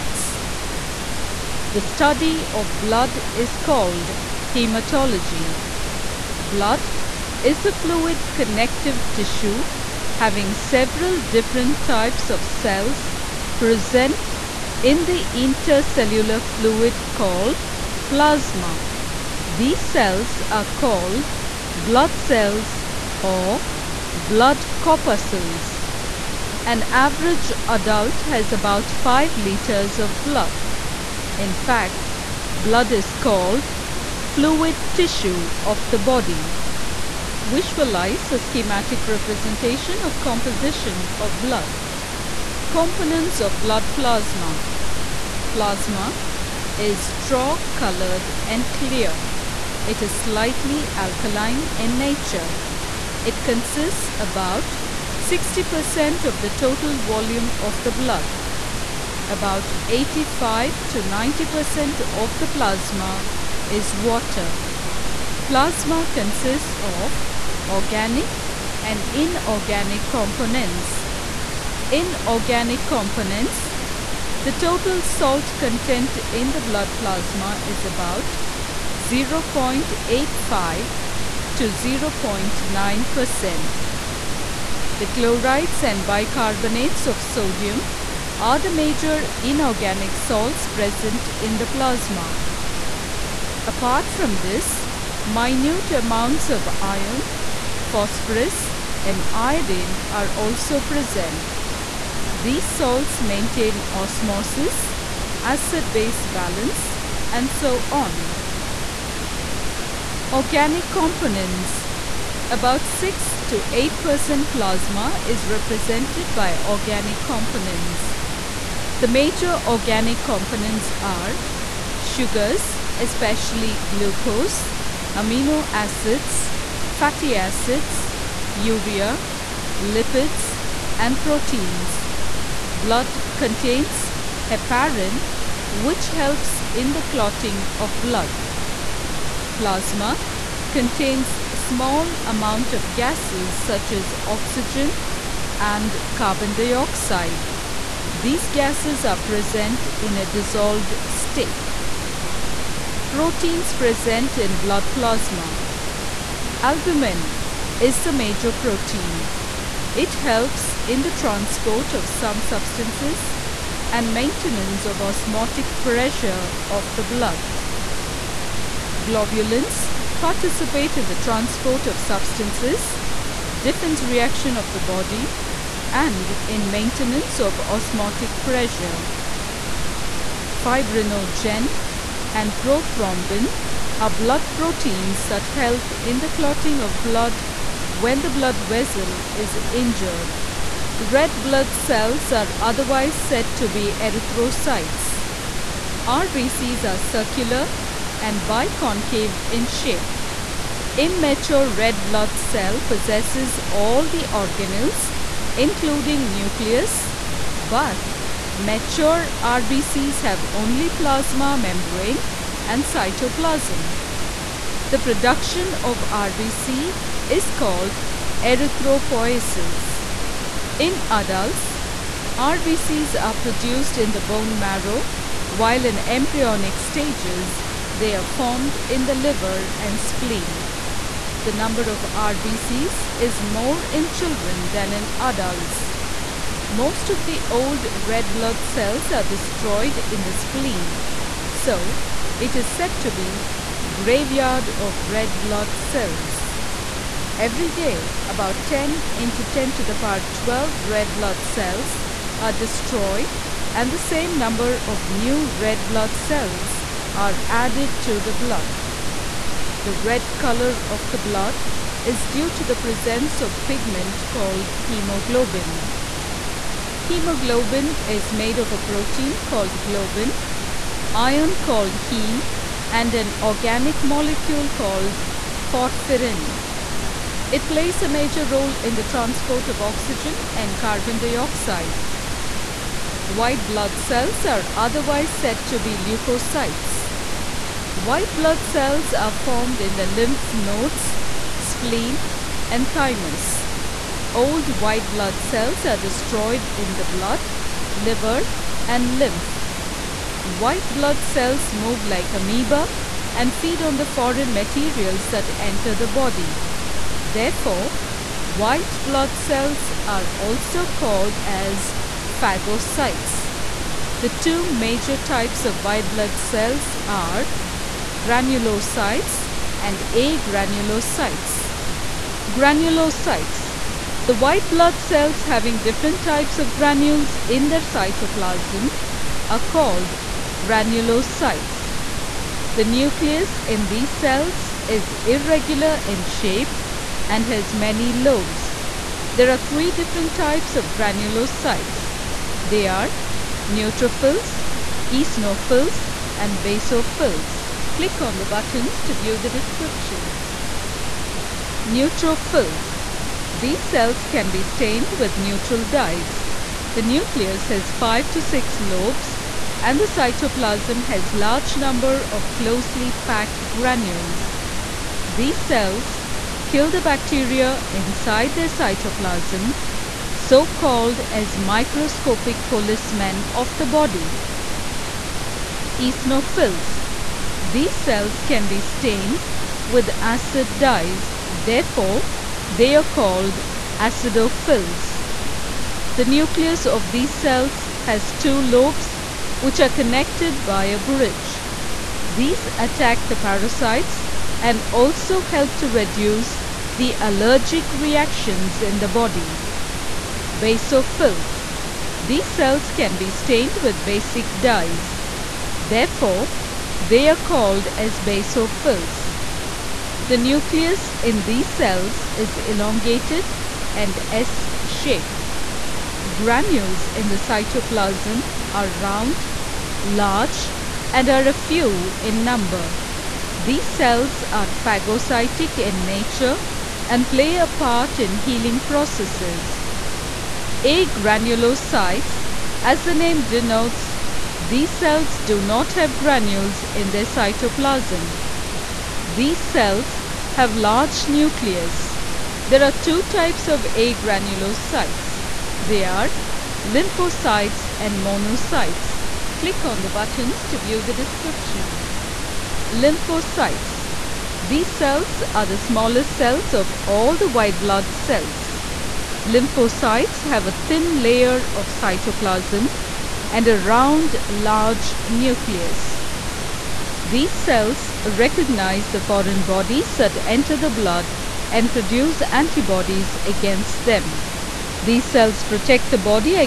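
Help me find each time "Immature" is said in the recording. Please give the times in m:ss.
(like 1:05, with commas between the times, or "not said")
3:20.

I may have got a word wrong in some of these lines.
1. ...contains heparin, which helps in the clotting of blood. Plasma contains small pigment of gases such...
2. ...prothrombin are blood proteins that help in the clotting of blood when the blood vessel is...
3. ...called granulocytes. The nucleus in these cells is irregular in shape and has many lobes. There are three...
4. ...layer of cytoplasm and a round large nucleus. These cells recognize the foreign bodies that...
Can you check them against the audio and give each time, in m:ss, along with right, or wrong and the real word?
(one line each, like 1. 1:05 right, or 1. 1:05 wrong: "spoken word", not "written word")
1. 2:13 wrong: "amount", not "pigment"
2. 3:02 right
3. 5:29 right
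4. 7:41 right.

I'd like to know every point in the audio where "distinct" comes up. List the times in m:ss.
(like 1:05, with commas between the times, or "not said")
not said.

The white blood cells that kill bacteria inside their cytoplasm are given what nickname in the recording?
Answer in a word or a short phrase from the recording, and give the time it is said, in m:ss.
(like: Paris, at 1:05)
microscopic policemen, at 6:11.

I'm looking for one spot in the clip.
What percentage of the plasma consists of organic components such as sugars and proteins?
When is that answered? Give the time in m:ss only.
1:52.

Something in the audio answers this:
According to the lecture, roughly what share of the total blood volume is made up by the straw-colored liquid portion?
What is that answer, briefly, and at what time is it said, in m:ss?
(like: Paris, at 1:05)
60%, at 0:55.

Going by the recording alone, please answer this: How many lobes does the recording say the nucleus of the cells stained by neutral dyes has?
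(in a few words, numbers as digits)
5 to 6.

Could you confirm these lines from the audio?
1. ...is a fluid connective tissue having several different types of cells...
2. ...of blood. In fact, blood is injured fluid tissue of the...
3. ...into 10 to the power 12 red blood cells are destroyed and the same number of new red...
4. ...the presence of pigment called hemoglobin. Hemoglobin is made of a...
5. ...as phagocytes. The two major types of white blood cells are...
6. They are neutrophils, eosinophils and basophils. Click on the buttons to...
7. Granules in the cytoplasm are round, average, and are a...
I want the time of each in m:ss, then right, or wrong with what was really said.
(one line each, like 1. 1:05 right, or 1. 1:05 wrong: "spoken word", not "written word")
1. 0:07 right
2. 0:29 wrong: "called", not "injured"
3. 4:09 right
4. 4:22 right
5. 5:11 right
6. 5:42 right
7. 6:56 wrong: "large", not "average".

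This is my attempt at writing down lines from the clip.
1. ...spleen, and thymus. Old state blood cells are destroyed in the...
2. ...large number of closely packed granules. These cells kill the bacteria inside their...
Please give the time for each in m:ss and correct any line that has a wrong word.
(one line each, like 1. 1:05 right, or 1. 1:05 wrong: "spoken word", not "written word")
1. 4:51 wrong: "white", not "state"
2. 6:01 right.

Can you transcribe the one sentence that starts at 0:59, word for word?
About 85 to 90% of the plasma is water.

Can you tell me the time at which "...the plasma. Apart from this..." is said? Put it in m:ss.
1:31.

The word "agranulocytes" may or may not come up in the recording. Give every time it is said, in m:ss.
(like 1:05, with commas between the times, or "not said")
5:20, 7:10, 7:23.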